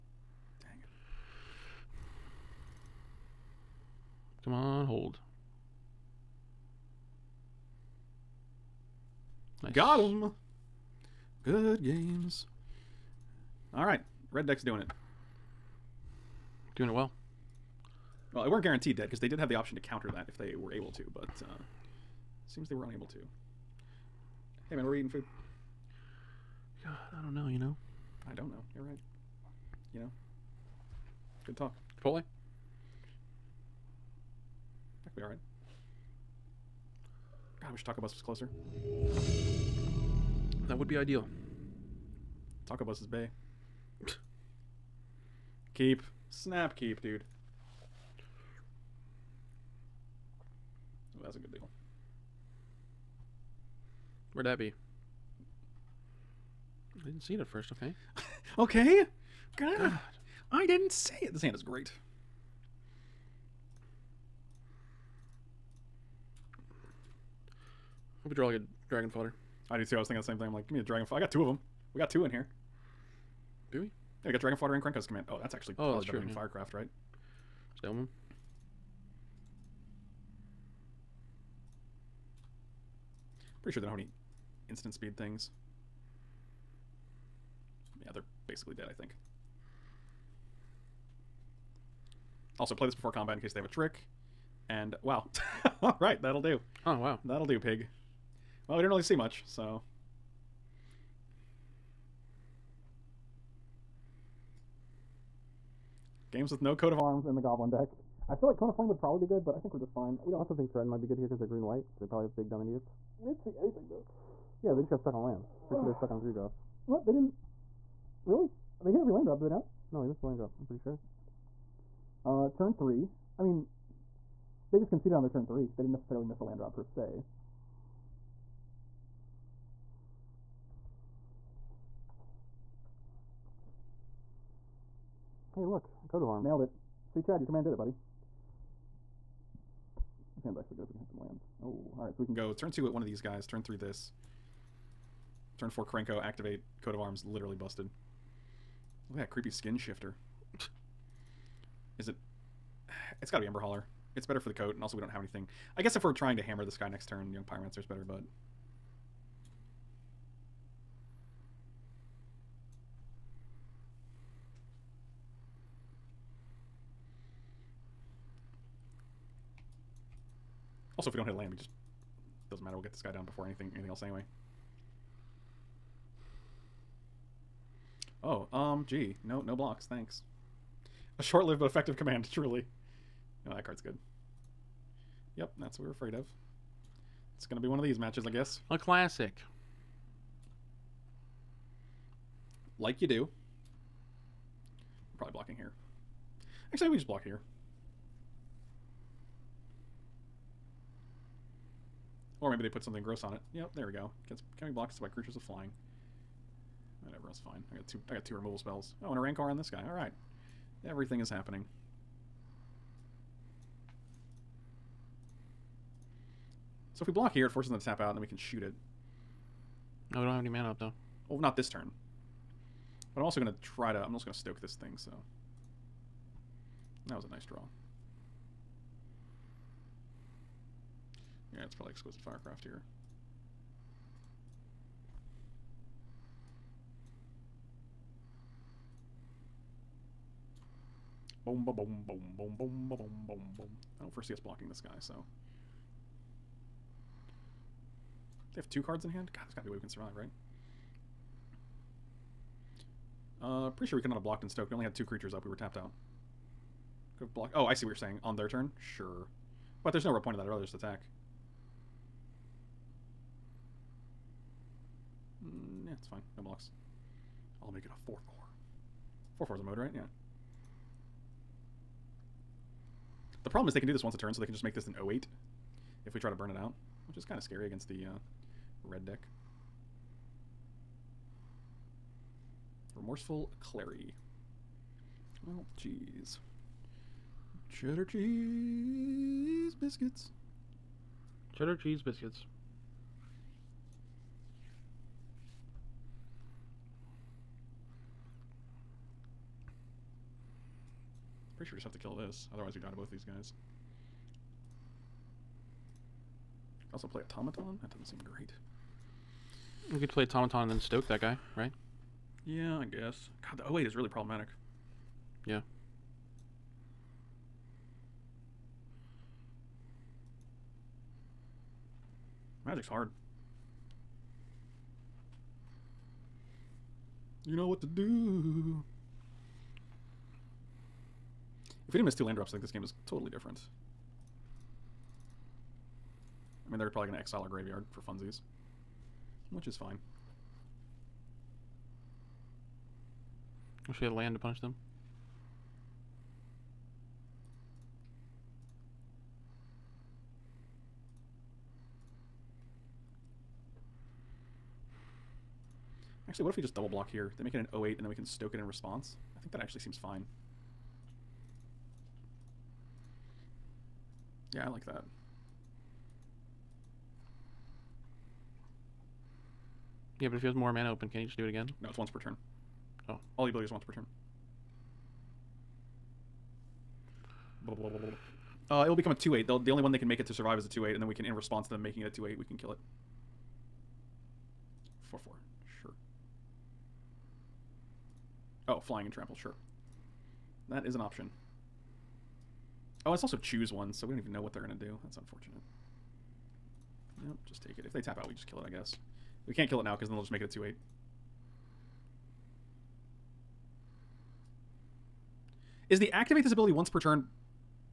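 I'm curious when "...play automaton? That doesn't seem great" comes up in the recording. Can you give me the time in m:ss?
5:07.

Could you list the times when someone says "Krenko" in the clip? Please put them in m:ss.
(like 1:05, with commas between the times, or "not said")
1:14, 2:25.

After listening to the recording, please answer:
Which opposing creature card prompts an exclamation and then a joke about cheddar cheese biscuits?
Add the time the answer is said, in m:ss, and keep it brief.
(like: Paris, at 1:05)
Remorseful Cleric, at 4:42.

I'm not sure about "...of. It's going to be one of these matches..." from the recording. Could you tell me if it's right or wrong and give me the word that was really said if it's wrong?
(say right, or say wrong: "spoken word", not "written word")
right.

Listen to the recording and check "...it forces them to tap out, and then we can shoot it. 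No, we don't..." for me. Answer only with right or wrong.
right.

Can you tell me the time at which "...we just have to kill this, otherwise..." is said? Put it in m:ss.
5:01.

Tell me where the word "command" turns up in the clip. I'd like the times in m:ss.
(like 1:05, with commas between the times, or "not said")
1:15, 2:17, 3:01.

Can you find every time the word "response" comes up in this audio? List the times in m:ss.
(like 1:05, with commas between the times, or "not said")
5:58, 6:21.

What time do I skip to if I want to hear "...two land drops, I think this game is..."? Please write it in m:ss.
5:32.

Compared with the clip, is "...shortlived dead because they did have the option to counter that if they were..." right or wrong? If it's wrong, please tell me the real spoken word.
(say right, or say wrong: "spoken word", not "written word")
wrong: "guaranteed", not "shortlived".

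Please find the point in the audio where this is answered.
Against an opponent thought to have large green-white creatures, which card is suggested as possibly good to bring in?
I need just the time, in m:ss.
1:50.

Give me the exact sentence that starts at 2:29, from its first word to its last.
Look at that creepy skin shifter.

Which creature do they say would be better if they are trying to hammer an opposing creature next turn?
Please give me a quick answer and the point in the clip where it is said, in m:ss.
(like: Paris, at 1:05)
Young Pyromancer, at 2:37.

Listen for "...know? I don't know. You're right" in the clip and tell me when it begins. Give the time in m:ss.
0:27.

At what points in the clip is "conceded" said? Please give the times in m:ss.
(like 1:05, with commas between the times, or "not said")
2:04.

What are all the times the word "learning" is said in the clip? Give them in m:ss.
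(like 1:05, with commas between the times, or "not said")
not said.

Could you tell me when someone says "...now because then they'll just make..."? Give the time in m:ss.
6:39.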